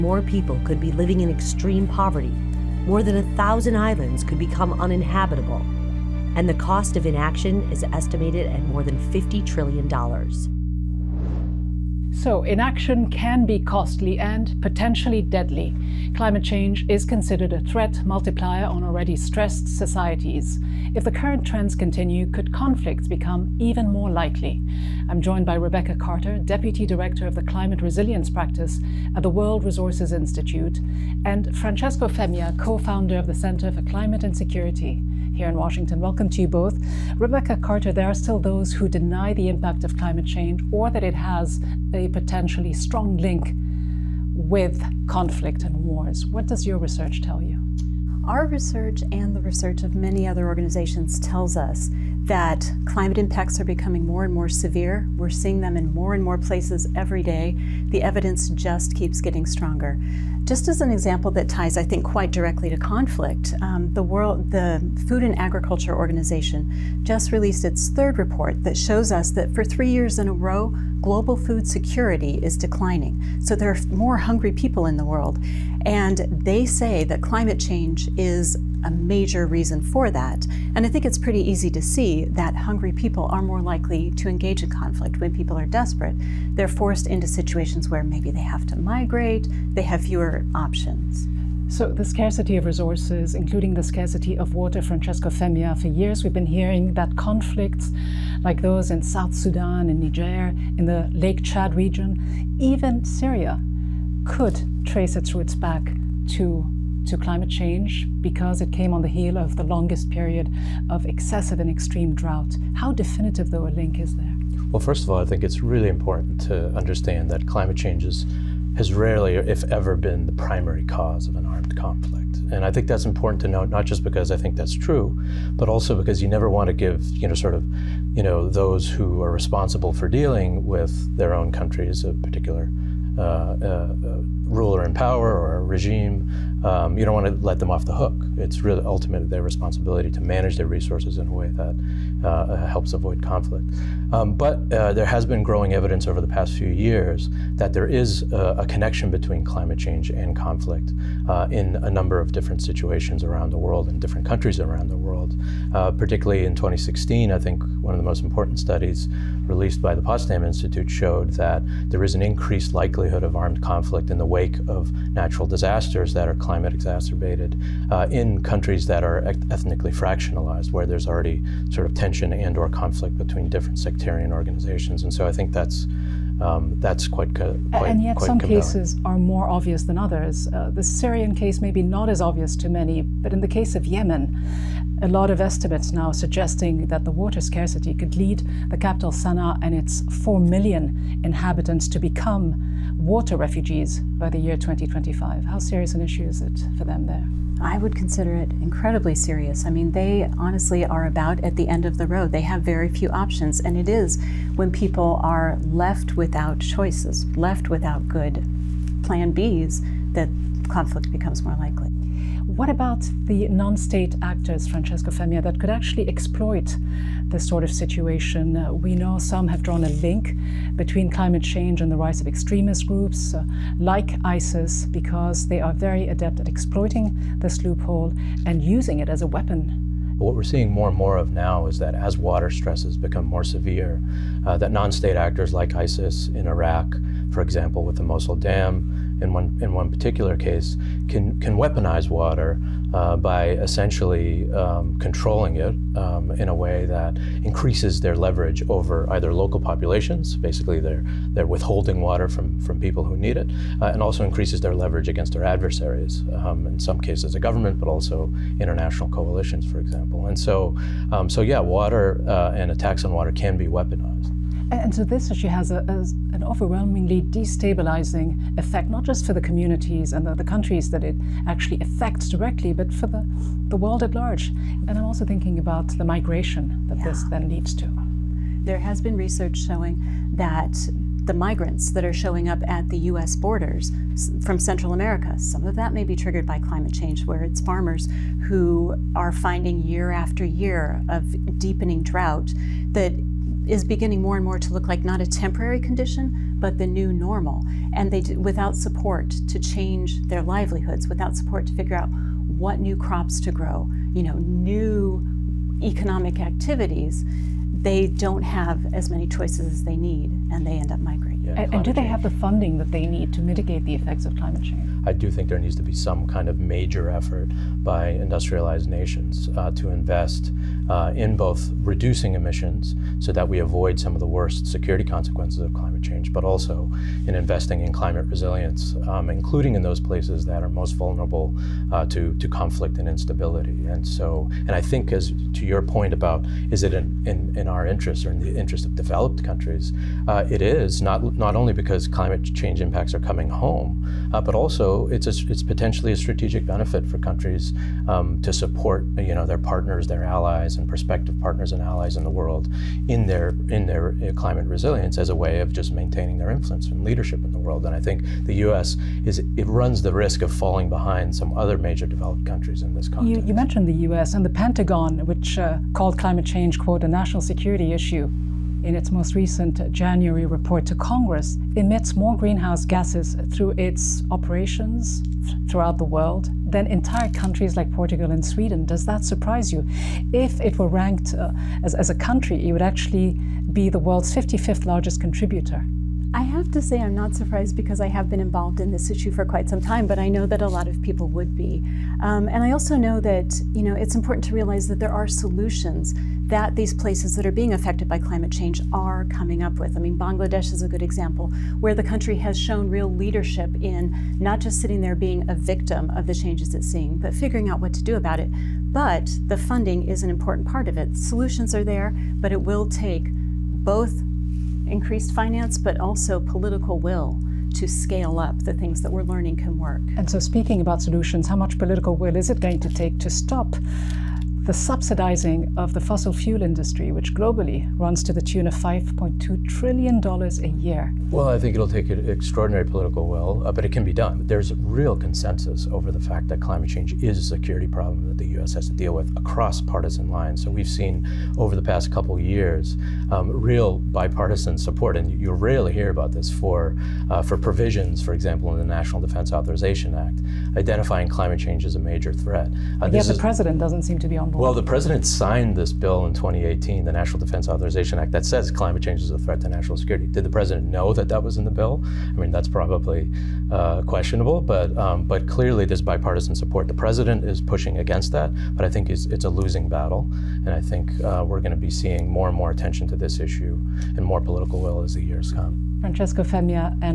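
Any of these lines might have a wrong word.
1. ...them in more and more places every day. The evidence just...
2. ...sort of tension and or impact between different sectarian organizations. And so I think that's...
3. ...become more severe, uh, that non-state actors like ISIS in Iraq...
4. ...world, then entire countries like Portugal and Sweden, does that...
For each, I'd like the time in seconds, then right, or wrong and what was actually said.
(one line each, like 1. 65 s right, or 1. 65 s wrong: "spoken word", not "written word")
1. 55 s right
2. 171 s wrong: "conflict", not "impact"
3. 232 s right
4. 376 s right.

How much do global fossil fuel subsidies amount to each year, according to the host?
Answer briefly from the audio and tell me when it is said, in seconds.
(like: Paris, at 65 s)
$5.2 trillion, at 428 s.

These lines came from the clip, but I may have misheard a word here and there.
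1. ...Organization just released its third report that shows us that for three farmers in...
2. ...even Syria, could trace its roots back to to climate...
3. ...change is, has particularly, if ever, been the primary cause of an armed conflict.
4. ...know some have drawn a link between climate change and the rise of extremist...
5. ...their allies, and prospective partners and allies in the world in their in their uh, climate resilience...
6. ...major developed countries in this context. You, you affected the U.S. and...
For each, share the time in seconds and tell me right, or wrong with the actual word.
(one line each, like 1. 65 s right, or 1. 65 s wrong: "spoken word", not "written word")
1. 65 s wrong: "years", not "farmers"
2. 102 s right
3. 117 s wrong: "rarely", not "particularly"
4. 218 s right
5. 350 s right
6. 361 s wrong: "mentioned", not "affected".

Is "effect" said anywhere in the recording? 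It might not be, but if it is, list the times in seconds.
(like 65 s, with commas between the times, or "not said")
268 s, 313 s.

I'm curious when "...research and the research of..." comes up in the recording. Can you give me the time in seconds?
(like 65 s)
48 s.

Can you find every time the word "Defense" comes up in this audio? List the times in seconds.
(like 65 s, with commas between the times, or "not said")
449 s, 457 s.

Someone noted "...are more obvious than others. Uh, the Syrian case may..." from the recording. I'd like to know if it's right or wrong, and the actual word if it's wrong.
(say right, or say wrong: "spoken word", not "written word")
right.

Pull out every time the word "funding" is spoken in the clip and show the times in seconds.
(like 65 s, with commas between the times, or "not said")
312 s, 409 s.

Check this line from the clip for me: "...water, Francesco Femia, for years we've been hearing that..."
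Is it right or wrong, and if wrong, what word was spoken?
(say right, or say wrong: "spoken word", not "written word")
right.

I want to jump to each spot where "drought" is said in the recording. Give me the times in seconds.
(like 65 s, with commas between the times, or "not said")
112 s, 292 s.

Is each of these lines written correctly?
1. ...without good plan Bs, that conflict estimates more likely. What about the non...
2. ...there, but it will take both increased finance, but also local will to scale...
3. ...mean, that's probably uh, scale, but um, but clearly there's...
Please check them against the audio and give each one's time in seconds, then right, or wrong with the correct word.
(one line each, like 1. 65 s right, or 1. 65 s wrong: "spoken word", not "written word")
1. 207 s wrong: "becomes", not "estimates"
2. 411 s wrong: "political", not "local"
3. 462 s wrong: "questionable", not "scale".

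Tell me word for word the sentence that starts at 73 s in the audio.
So there are more hungry people in the world.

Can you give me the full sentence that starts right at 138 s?
It's really ultimately their responsibility to manage their resources in a way that uh, uh, helps avoid conflict.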